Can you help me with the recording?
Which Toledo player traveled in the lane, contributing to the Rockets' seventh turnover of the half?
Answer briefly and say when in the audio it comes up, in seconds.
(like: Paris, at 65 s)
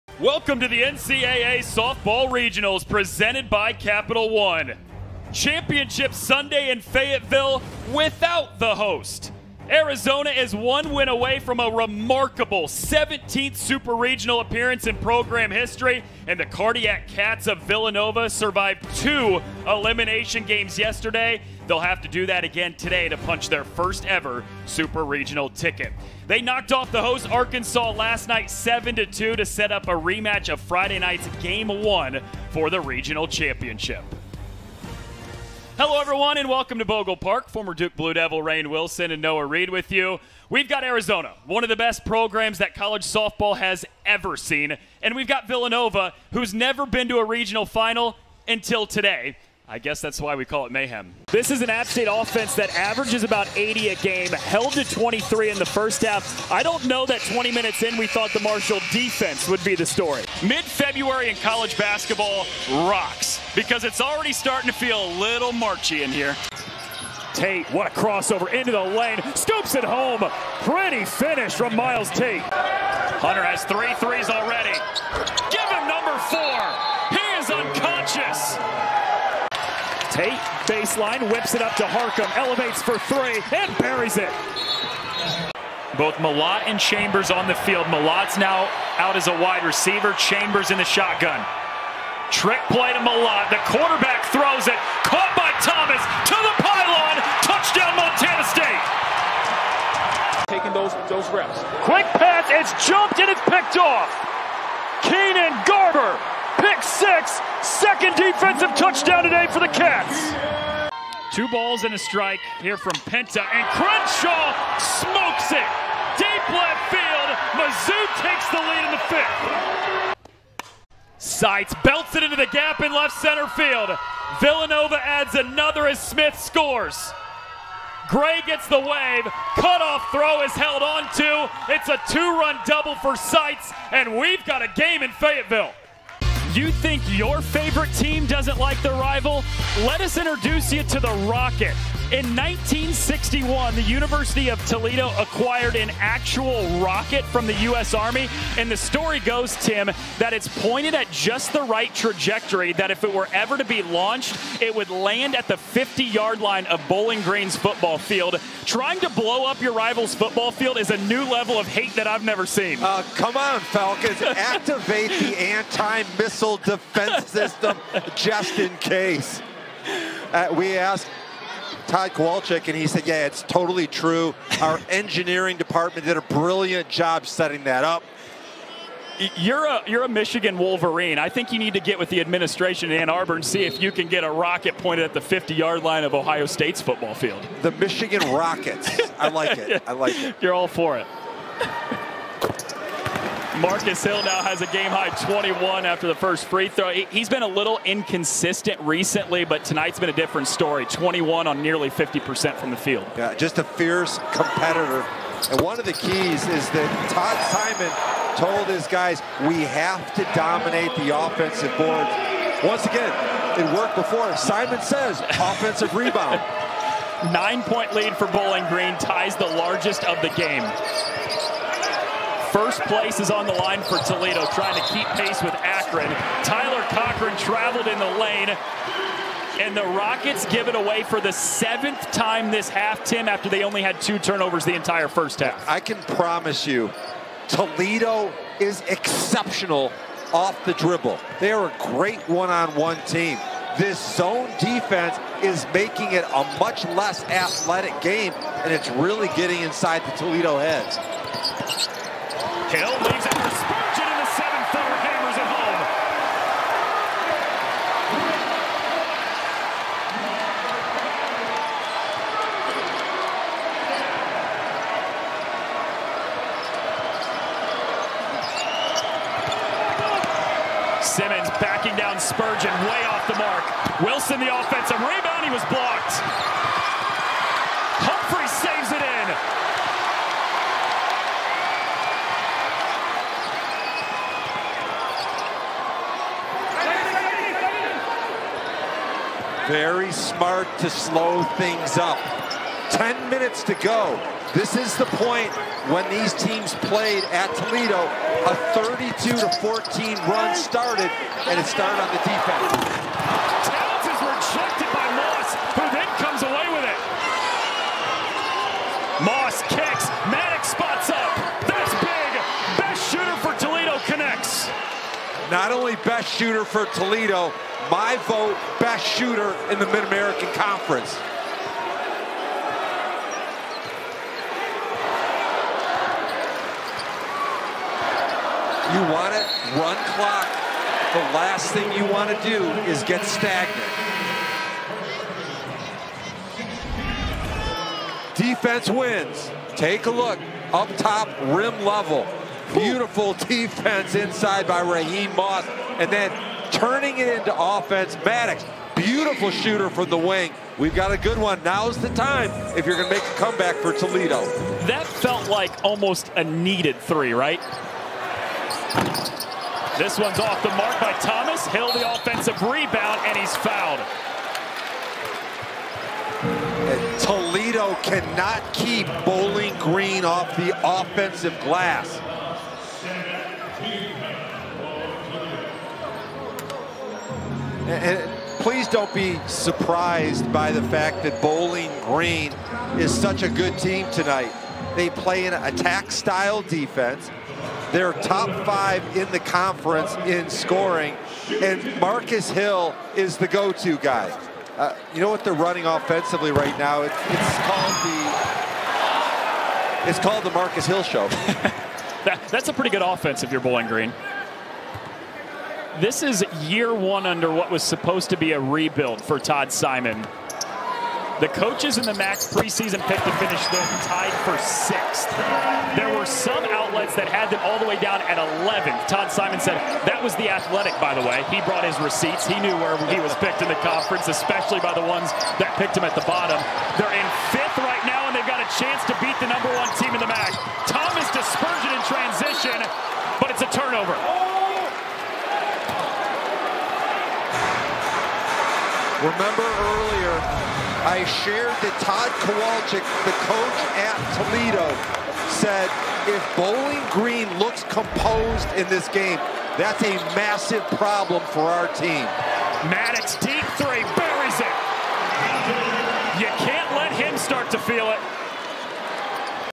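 Tyler Cochran, at 226 s.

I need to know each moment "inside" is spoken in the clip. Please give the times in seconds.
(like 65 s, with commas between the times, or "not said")
249 s, 344 s.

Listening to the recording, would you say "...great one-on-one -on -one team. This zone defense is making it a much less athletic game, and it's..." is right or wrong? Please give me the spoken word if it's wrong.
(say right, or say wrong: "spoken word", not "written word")
right.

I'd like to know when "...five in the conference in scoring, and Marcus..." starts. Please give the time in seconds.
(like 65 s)
388 s.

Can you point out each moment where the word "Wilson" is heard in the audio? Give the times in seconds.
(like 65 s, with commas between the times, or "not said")
38 s, 273 s.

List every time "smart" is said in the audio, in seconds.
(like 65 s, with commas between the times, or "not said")
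290 s.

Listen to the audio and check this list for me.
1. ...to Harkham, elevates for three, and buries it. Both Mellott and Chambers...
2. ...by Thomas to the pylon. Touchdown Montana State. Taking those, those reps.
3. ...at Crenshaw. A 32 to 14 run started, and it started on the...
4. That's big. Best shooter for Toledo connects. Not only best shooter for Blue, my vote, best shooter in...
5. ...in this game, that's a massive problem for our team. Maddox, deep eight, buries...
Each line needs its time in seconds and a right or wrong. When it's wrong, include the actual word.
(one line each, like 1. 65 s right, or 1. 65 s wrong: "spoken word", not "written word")
1. 81 s right
2. 95 s right
3. 297 s wrong: "Toledo", not "Crenshaw"
4. 311 s wrong: "Toledo", not "Blue"
5. 448 s wrong: "three", not "eight".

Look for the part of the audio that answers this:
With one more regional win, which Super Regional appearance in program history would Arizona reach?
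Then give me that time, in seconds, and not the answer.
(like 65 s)
12 s.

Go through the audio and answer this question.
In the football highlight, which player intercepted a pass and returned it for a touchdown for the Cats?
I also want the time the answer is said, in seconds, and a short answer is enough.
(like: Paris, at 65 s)
Keenan Garber, at 105 s.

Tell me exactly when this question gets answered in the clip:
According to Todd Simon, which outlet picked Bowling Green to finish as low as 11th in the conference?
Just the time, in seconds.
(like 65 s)
420 s.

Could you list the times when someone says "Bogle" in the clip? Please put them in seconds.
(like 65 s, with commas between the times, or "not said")
36 s.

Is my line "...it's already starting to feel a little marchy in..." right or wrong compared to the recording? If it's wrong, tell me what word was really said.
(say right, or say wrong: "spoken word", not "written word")
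right.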